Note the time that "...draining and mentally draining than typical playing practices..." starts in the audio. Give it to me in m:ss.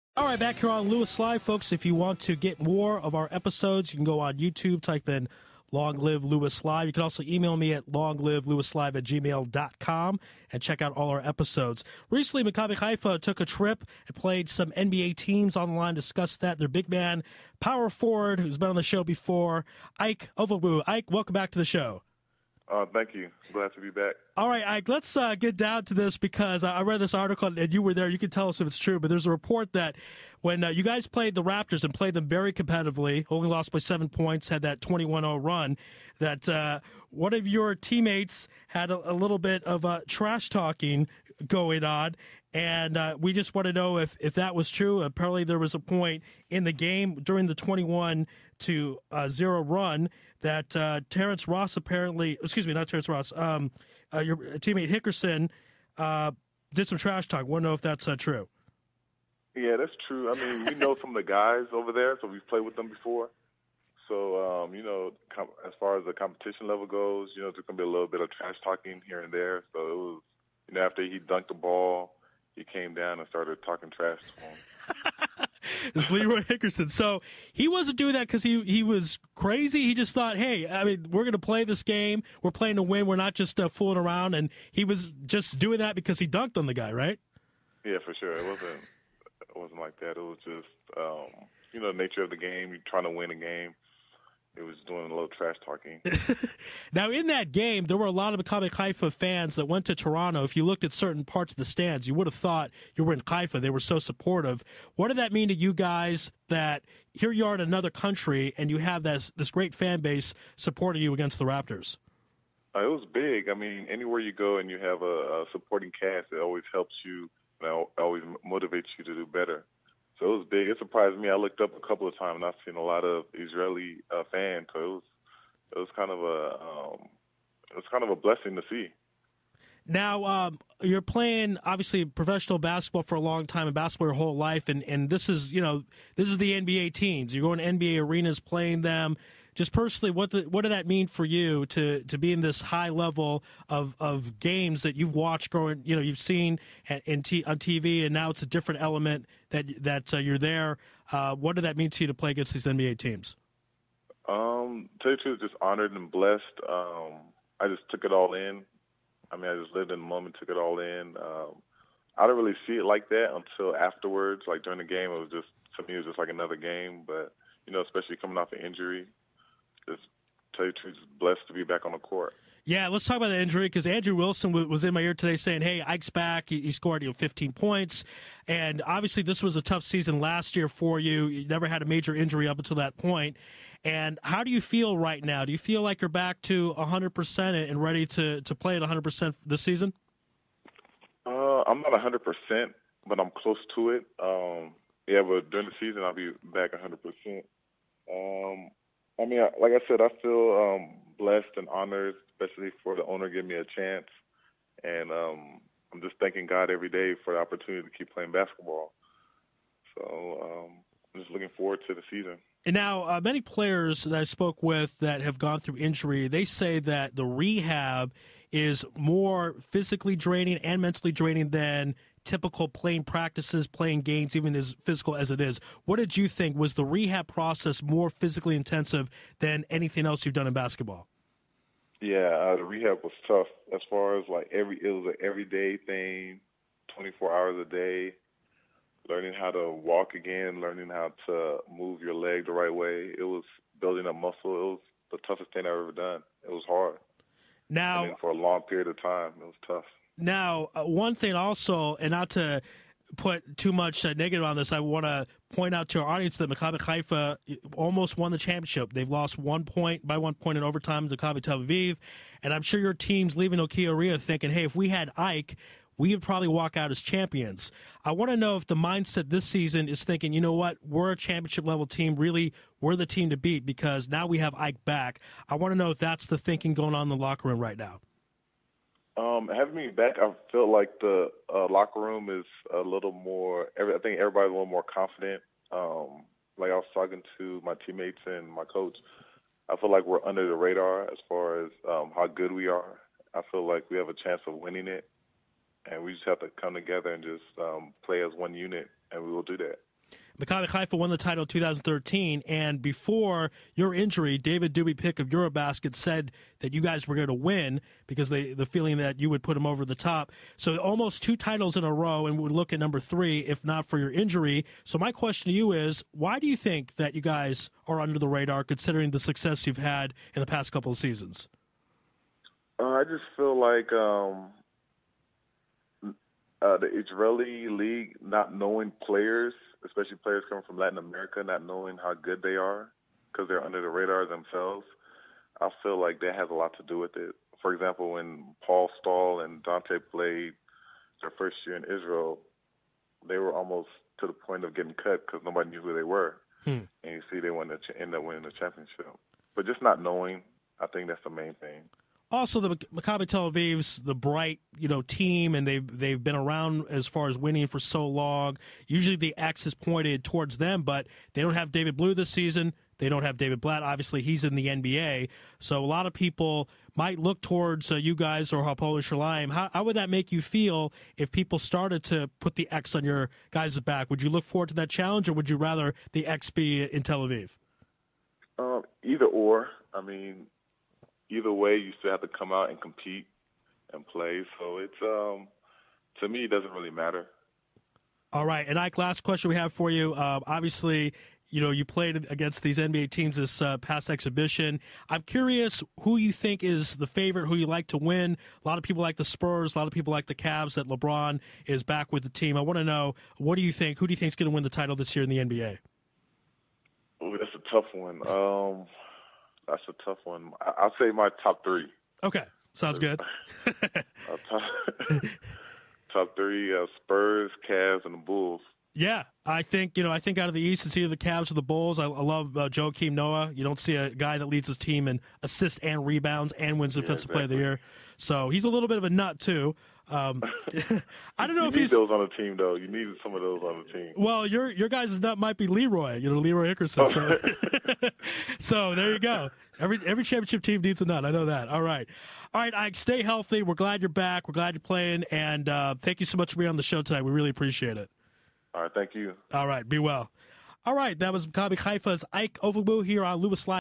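3:40.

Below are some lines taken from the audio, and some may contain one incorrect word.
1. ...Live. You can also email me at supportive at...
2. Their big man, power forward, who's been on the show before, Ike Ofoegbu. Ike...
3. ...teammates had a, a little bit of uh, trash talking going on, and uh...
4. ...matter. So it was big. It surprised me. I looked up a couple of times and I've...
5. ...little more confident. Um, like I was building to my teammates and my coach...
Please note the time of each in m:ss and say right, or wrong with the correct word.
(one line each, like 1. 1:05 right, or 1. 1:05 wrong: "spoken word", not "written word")
1. 0:06 wrong: "longlivelewislive", not "supportive"
2. 0:16 right
3. 0:37 right
4. 1:59 wrong: "better", not "matter"
5. 4:44 wrong: "talking", not "building".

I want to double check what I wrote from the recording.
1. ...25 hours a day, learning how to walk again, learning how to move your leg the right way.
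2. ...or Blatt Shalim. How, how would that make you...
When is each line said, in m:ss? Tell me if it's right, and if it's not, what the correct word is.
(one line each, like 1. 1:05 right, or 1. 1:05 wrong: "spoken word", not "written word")
1. 3:56 wrong: "24", not "25"
2. 6:08 wrong: "Hapoel", not "Blatt".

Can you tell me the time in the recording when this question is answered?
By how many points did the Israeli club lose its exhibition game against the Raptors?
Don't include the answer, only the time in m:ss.
0:33.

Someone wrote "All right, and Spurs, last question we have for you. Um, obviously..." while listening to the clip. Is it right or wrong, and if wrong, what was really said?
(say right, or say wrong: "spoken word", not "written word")
wrong: "Ike", not "Spurs".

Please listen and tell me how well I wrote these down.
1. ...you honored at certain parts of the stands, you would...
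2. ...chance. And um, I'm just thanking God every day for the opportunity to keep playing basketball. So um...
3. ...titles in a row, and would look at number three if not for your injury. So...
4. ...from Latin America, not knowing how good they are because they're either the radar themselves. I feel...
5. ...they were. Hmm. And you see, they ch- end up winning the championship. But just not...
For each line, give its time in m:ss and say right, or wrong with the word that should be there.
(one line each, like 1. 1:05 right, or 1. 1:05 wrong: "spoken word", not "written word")
1. 1:40 wrong: "looked", not "honored"
2. 3:23 right
3. 5:11 right
4. 5:30 wrong: "under", not "either"
5. 5:45 right.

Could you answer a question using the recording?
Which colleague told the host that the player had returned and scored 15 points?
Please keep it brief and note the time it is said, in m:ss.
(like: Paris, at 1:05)
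Andrew Wilson, at 2:53.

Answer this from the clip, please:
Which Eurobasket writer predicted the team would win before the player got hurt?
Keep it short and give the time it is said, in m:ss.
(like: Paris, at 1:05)
David Doobie Pick, at 5:04.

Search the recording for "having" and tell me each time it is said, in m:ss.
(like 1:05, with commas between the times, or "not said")
4:39.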